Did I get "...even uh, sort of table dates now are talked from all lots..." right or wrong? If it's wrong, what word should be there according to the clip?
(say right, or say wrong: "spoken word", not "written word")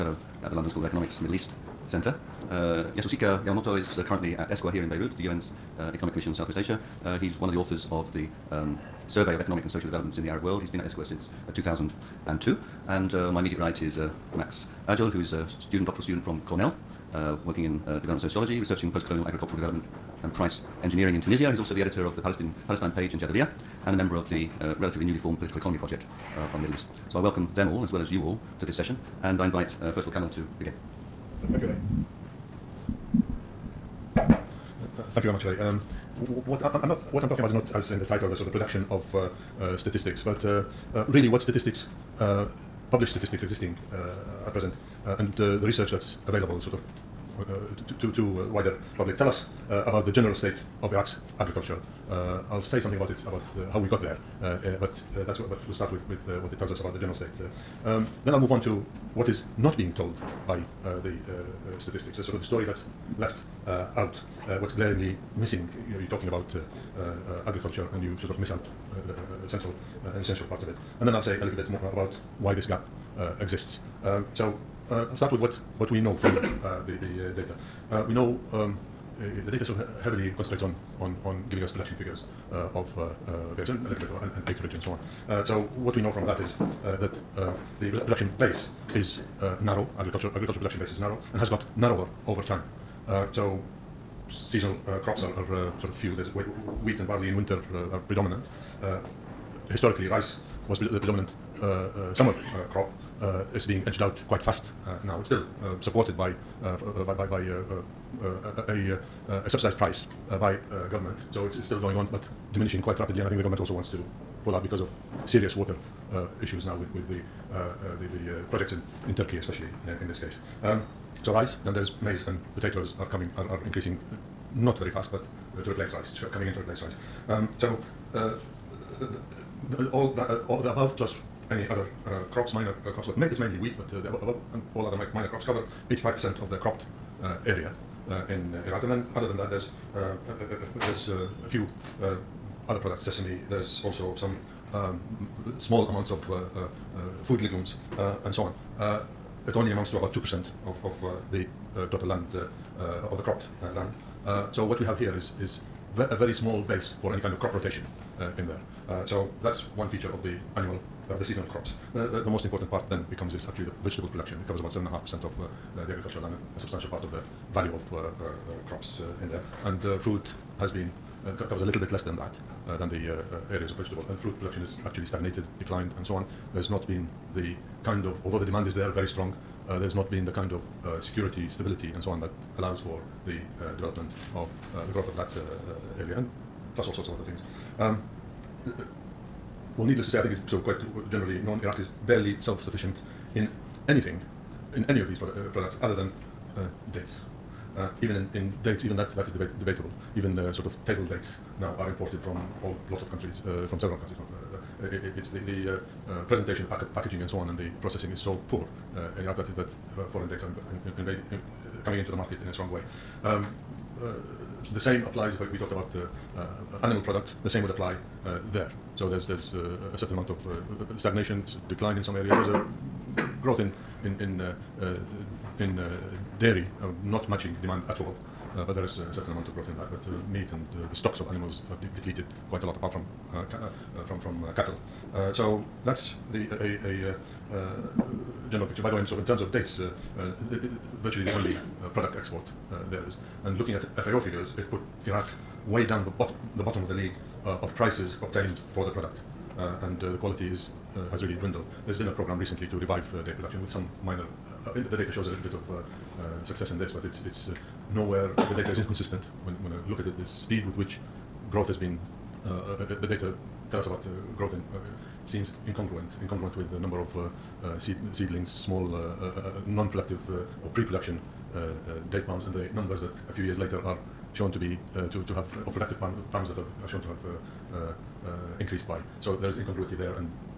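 wrong: "imported", not "talked".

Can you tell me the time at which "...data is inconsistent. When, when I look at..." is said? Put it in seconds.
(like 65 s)
258 s.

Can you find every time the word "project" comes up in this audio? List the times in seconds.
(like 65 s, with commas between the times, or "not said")
25 s, 118 s.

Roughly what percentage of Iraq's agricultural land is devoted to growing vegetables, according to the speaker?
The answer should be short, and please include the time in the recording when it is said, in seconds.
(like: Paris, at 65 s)
7.5%, at 164 s.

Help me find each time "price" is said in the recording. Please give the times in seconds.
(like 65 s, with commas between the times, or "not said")
20 s, 109 s, 247 s.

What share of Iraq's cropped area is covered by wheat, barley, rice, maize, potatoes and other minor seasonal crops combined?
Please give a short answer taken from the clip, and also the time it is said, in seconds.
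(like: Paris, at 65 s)
85%, at 135 s.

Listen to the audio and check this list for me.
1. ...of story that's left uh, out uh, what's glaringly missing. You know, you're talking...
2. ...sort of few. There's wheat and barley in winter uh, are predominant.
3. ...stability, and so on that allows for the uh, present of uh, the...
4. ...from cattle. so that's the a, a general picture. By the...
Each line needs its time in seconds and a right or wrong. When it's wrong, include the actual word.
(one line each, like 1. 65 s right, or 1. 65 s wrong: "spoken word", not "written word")
1. 62 s right
2. 95 s right
3. 181 s wrong: "development", not "present"
4. 234 s right.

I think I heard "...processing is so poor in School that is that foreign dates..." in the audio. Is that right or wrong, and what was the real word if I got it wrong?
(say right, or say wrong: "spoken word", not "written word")
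wrong: "Iraq", not "School".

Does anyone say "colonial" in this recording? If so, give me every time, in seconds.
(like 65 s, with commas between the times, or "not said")
18 s.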